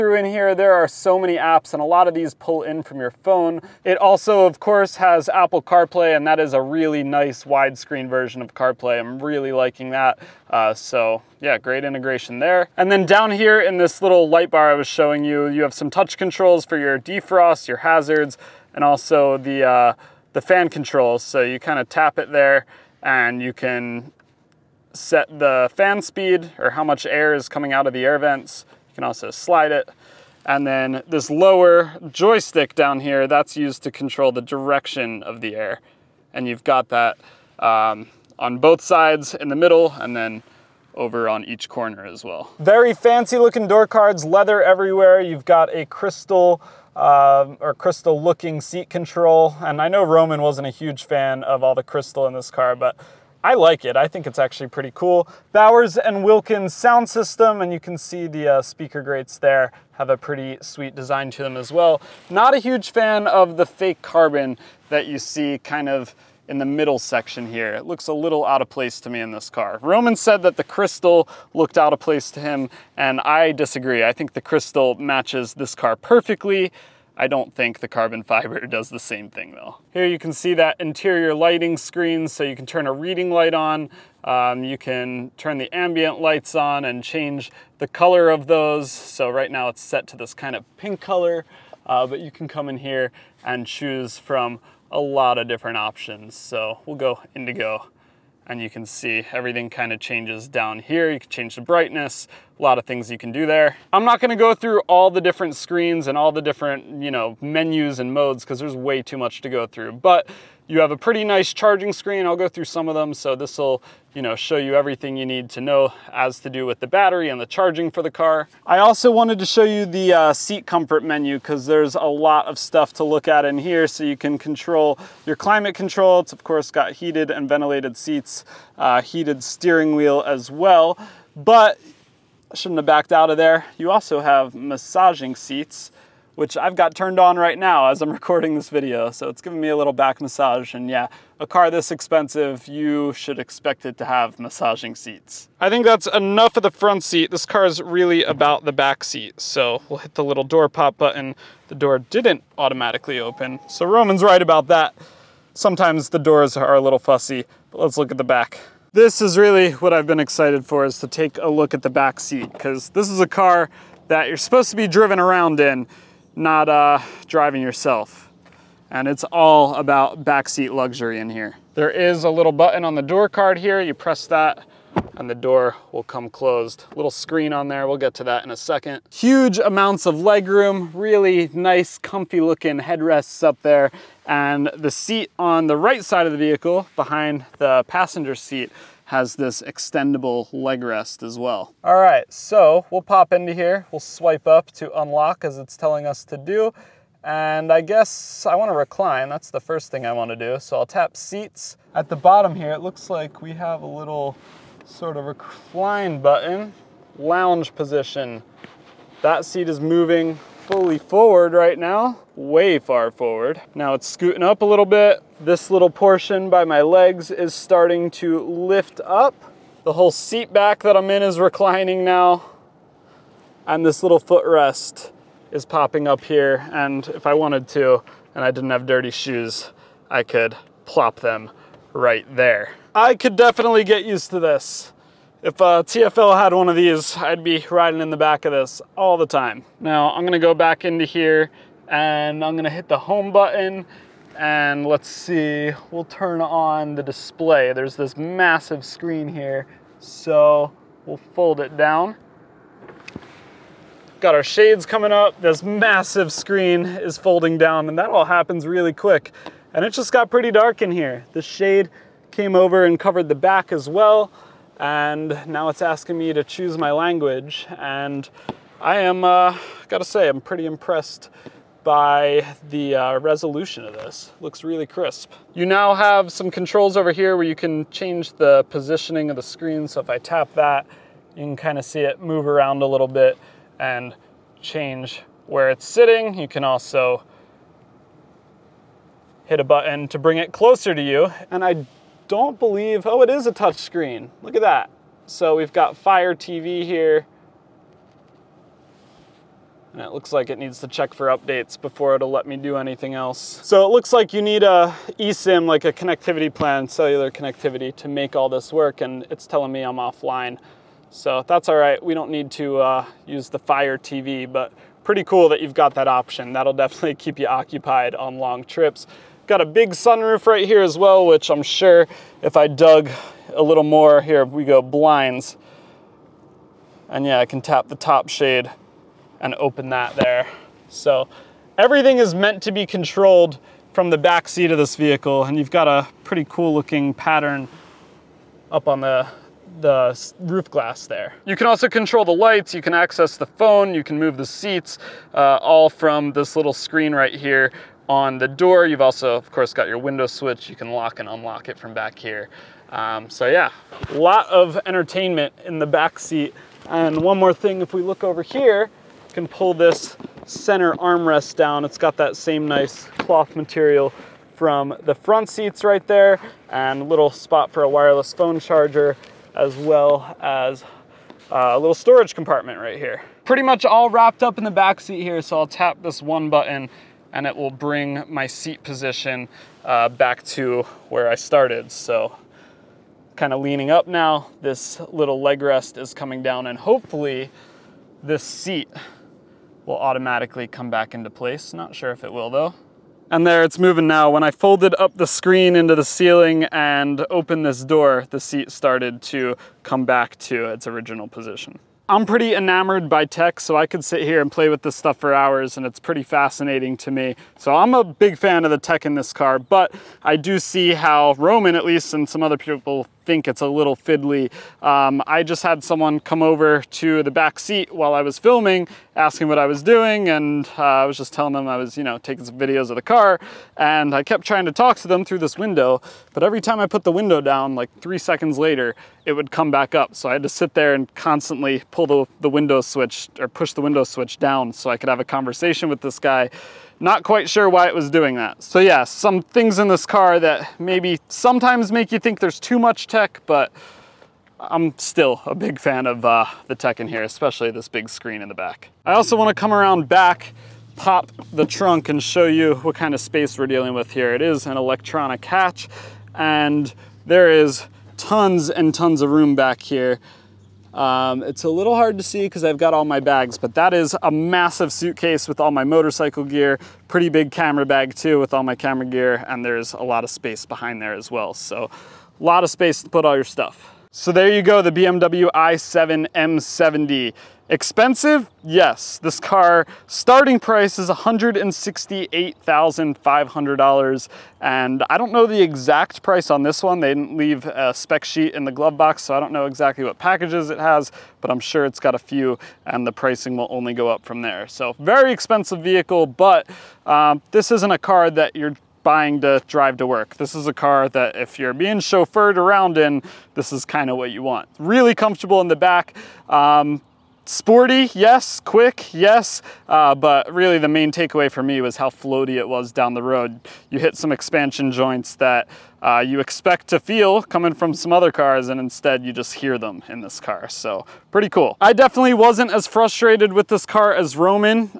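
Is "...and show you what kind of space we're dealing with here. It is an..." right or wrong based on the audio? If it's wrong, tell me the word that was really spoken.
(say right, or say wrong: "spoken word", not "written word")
right.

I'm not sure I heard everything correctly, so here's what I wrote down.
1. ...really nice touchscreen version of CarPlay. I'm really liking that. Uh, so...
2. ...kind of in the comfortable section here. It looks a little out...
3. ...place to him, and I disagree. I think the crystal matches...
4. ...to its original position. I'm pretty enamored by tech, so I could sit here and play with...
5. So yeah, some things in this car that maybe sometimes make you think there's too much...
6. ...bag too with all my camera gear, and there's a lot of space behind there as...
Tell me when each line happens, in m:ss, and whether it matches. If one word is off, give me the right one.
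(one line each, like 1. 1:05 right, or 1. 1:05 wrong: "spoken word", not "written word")
1. 0:06 wrong: "widescreen", not "touchscreen"
2. 1:05 wrong: "middle", not "comfortable"
3. 1:11 right
4. 6:40 right
5. 7:18 right
6. 7:47 right.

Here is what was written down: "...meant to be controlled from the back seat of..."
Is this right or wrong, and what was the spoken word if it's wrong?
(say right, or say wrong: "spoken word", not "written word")
right.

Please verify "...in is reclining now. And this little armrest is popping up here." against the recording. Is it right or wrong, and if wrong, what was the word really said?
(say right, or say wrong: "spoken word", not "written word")
wrong: "footrest", not "armrest".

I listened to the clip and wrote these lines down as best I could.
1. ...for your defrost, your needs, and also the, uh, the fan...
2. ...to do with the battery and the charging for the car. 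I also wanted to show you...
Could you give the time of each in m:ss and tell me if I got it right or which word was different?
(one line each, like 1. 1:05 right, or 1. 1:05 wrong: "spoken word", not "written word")
1. 0:16 wrong: "hazards", not "needs"
2. 1:56 right.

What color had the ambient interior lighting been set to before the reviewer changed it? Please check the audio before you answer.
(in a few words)
Pink.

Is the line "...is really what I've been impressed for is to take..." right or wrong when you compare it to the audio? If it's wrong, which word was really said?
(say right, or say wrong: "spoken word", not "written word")
wrong: "excited", not "impressed".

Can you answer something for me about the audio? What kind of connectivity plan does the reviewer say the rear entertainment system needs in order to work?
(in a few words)
eSIM.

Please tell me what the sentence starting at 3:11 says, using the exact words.
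All right, so we'll pop into here.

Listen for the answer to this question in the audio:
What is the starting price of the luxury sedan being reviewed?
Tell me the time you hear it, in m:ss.
8:01.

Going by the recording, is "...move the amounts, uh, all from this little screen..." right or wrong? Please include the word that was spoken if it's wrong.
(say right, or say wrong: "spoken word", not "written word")
wrong: "seats", not "amounts".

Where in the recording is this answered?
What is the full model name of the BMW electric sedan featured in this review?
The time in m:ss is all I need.
7:55.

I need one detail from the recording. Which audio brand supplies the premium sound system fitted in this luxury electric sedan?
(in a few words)
Bowers and Wilkins.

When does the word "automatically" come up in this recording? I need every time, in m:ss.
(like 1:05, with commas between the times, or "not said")
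2:32, 6:29.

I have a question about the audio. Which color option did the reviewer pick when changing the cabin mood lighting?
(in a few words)
Indigo.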